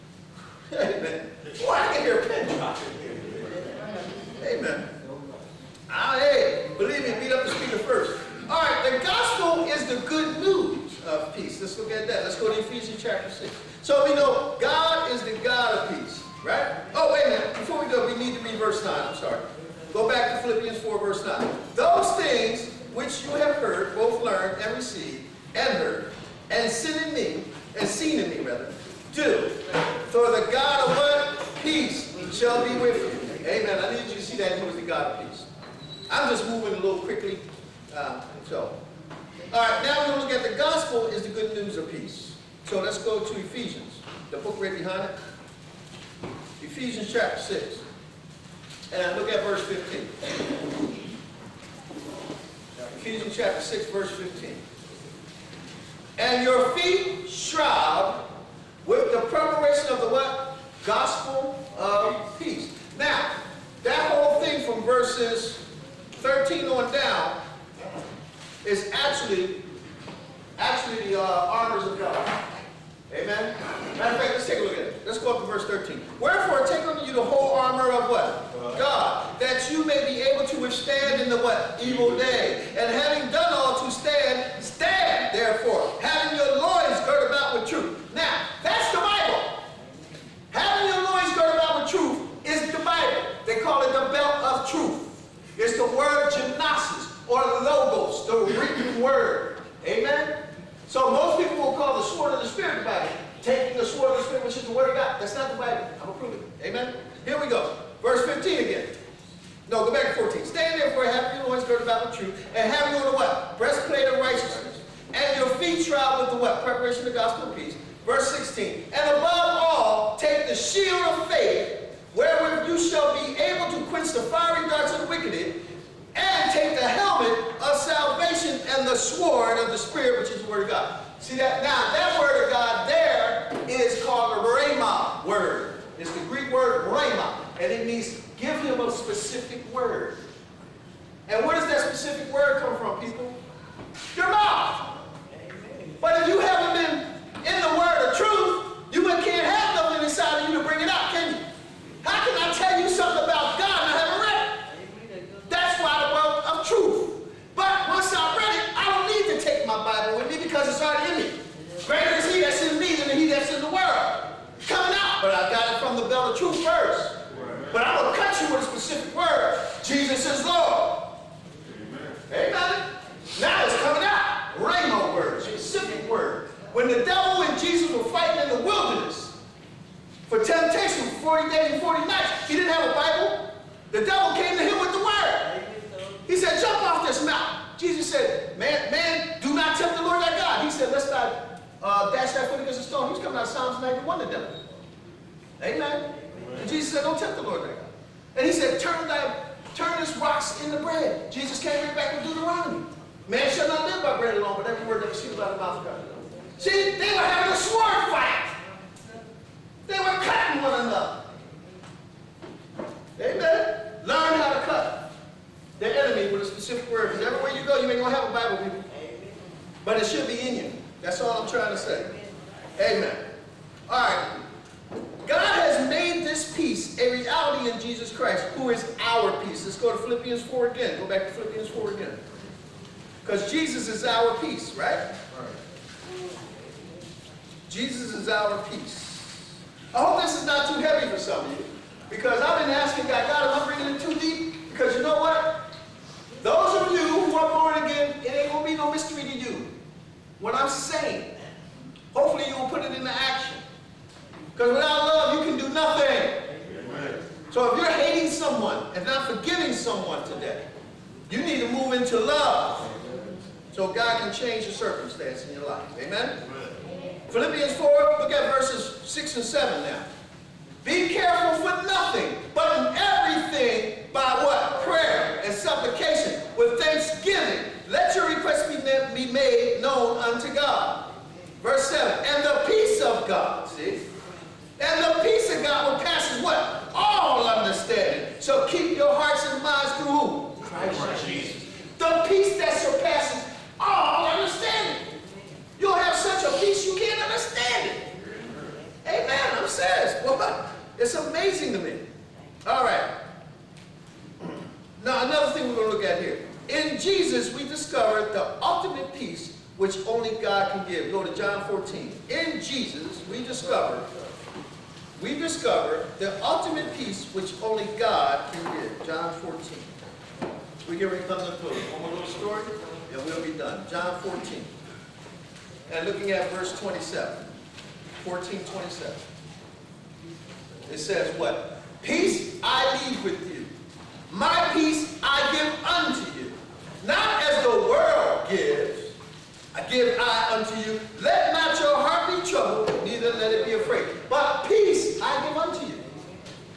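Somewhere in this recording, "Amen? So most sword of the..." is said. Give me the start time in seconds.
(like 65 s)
99 s.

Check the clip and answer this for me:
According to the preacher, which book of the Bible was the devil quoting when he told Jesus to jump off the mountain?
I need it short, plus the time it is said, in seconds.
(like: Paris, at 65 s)
Psalms 91, at 193 s.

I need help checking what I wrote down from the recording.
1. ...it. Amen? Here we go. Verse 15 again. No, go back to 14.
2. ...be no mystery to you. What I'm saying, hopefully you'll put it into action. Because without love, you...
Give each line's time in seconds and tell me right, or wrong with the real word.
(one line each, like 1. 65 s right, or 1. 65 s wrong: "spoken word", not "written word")
1. 106 s right
2. 248 s right.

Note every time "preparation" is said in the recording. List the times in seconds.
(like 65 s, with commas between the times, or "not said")
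59 s, 116 s.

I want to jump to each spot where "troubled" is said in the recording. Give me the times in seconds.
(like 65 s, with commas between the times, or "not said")
342 s.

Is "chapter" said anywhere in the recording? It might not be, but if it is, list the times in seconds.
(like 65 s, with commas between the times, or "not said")
13 s, 47 s, 53 s.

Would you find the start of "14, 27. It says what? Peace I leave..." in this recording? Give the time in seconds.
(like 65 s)
328 s.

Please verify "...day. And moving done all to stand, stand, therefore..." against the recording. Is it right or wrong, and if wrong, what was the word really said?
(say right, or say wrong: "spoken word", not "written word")
wrong: "having", not "moving".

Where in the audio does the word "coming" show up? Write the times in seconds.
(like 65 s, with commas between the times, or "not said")
173 s, 193 s.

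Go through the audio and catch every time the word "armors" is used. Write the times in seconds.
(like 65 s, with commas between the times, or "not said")
71 s, 77 s.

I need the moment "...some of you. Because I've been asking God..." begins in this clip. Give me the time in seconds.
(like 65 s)
241 s.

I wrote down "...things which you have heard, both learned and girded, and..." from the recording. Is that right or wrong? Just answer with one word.
wrong.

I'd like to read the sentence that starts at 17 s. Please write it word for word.
Before we go, we need to read verse 9.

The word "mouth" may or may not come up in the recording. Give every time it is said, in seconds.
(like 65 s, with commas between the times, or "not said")
144 s, 205 s.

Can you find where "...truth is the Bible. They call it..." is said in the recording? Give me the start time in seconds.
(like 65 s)
91 s.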